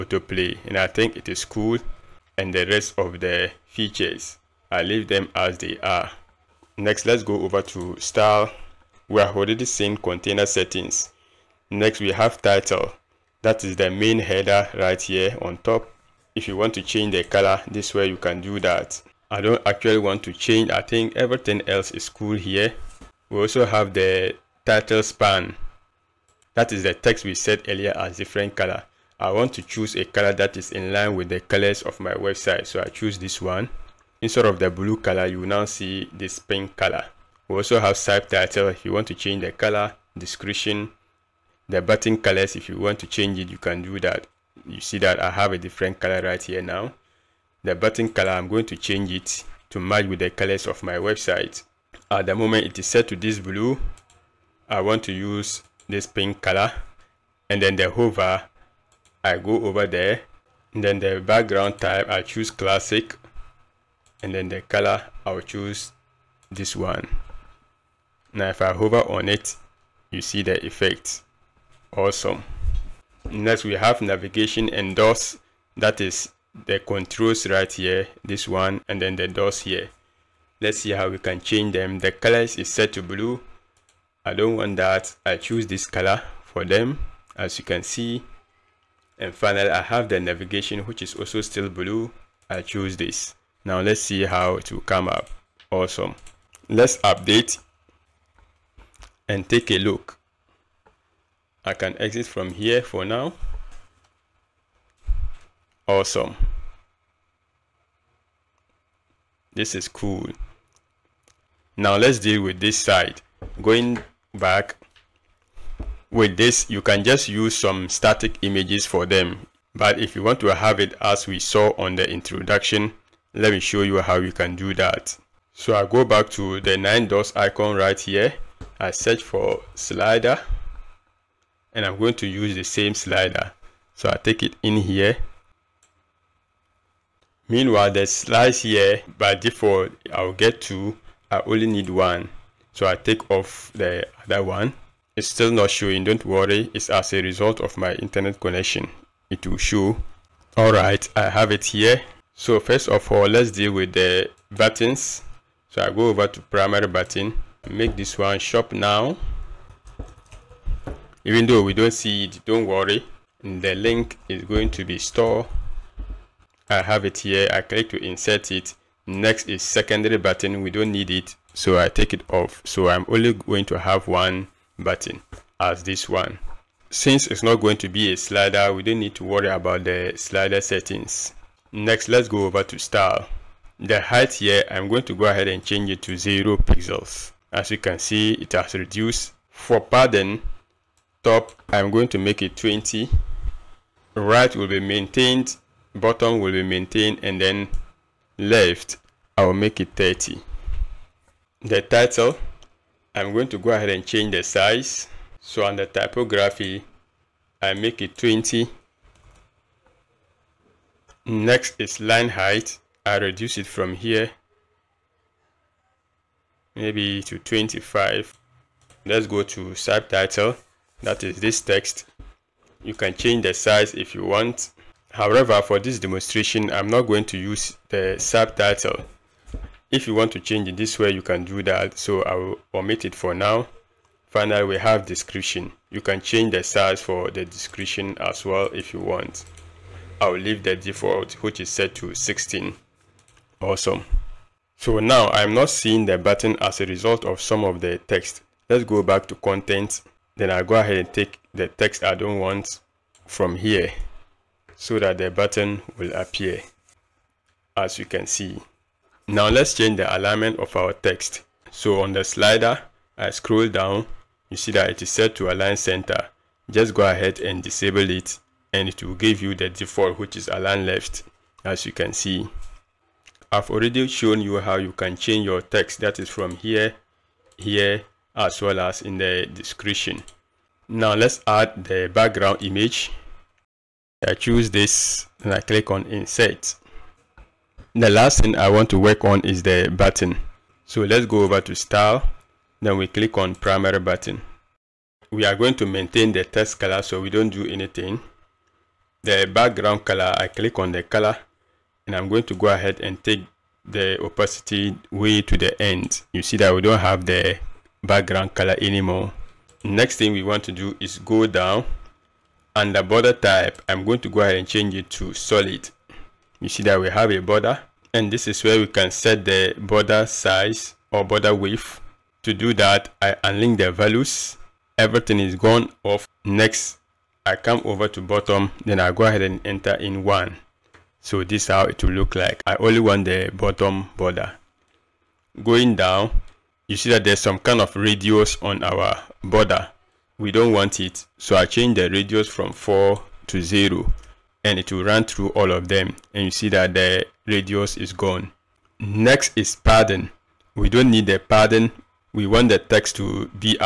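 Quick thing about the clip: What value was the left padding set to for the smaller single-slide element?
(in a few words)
30.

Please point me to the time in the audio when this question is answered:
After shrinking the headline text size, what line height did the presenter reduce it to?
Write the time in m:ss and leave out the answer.
3:36.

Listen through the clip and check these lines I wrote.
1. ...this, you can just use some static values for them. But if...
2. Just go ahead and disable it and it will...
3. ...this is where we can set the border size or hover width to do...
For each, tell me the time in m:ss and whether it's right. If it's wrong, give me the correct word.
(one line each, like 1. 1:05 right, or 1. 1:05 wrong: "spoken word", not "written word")
1. 1:56 wrong: "images", not "values"
2. 4:26 right
3. 5:18 wrong: "border", not "hover".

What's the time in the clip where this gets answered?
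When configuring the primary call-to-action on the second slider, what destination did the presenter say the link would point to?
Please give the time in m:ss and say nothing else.
2:43.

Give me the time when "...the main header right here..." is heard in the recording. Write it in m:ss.
0:13.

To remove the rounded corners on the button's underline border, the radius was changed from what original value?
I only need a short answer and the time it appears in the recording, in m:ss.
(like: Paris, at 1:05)
4, at 5:42.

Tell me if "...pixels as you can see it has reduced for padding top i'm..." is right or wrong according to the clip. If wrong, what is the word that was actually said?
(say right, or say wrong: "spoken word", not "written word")
right.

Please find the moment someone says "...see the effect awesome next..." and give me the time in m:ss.
1:10.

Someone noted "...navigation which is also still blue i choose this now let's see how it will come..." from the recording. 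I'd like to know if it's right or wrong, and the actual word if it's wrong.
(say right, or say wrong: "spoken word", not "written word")
right.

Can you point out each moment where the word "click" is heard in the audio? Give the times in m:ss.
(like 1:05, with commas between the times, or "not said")
2:47, 4:45, 4:53, 5:00.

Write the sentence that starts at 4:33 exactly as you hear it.
I've already shown you how you can change your text that is from here, here as well as in the description.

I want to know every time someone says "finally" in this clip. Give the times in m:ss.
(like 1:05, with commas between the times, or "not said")
1:29, 3:54.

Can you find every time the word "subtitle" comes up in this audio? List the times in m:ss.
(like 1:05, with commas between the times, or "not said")
0:37, 3:39, 3:48.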